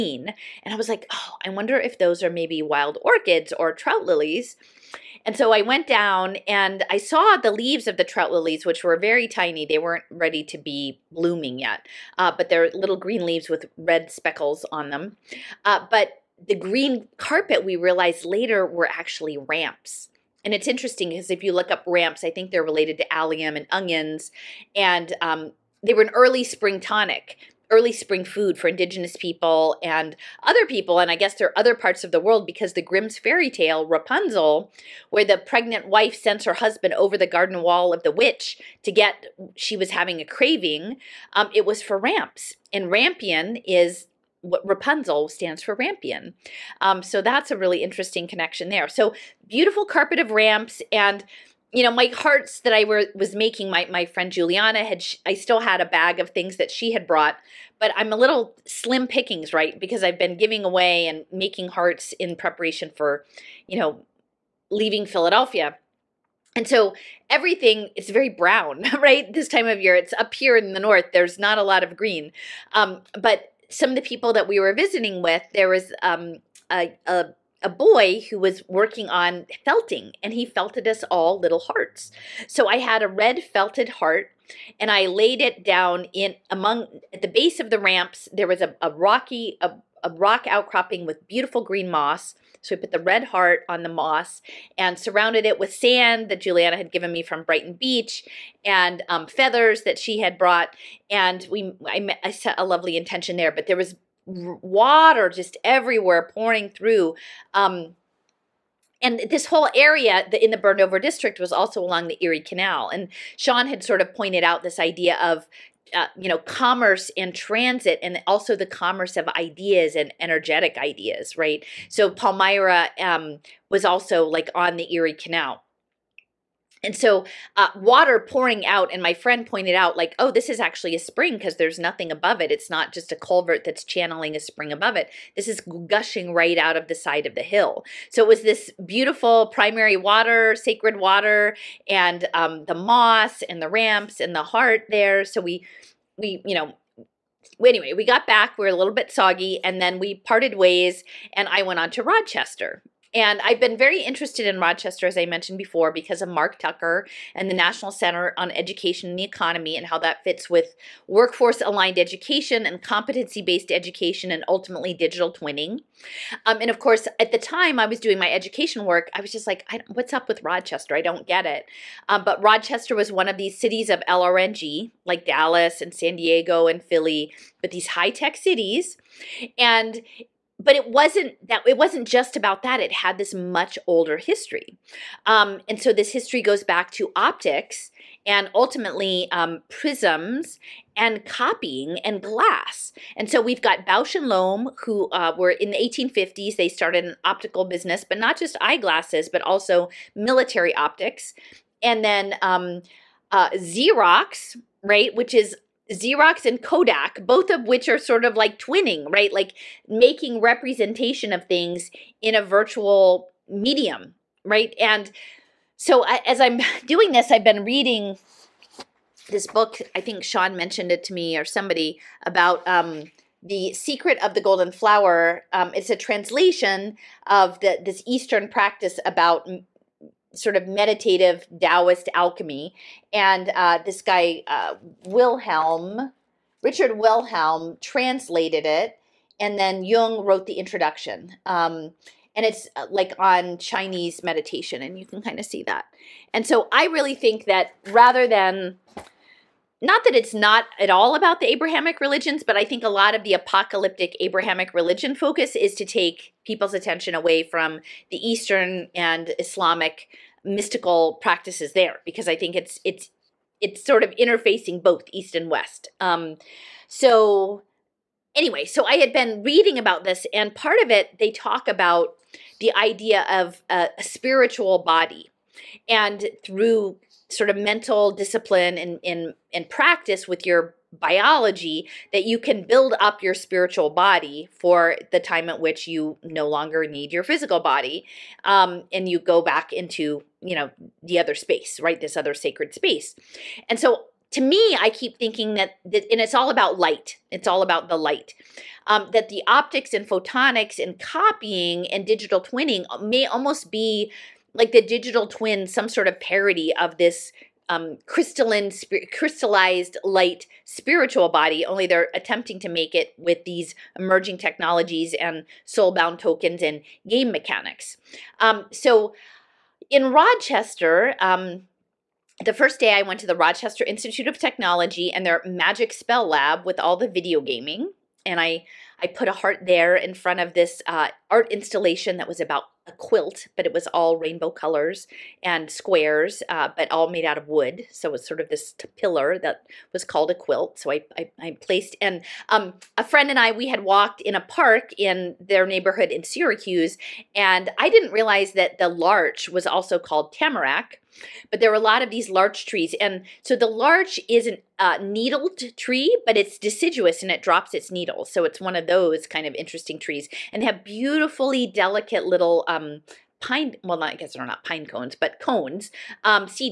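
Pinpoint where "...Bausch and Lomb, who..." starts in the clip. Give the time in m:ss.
3:13.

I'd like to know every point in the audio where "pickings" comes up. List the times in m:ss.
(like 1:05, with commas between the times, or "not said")
0:59.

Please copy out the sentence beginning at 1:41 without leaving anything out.
And we, I, met, I set a lovely intention there, but there was water just everywhere pouring through.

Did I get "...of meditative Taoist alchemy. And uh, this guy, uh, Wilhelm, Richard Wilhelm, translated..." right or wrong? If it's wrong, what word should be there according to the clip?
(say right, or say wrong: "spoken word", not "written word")
right.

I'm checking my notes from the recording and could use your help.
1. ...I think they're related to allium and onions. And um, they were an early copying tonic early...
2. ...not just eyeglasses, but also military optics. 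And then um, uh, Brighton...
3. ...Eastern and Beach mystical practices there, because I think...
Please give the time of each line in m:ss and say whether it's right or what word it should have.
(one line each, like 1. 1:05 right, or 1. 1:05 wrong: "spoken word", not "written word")
1. 0:22 wrong: "spring", not "copying"
2. 3:18 wrong: "Xerox", not "Brighton"
3. 4:18 wrong: "Islamic", not "Beach".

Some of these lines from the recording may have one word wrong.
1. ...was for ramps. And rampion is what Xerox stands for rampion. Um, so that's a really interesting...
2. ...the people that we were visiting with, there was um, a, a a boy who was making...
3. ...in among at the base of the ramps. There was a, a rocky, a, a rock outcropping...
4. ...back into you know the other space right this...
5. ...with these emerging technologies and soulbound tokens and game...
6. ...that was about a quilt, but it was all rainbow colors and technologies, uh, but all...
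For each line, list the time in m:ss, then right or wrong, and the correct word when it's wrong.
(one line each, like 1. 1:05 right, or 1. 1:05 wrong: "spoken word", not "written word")
1. 0:41 wrong: "Rapunzel", not "Xerox"
2. 1:13 wrong: "working", not "making"
3. 1:26 right
4. 4:49 right
5. 5:13 right
6. 5:32 wrong: "squares", not "technologies".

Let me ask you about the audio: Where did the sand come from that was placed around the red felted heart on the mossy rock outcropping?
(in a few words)
Brighton Beach.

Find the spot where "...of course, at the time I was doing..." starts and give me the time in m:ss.
2:46.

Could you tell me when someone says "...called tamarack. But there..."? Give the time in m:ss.
5:49.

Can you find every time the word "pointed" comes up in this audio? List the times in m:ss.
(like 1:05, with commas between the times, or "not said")
1:54, 2:09.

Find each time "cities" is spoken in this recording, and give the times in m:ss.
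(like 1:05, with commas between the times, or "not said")
2:53, 2:58.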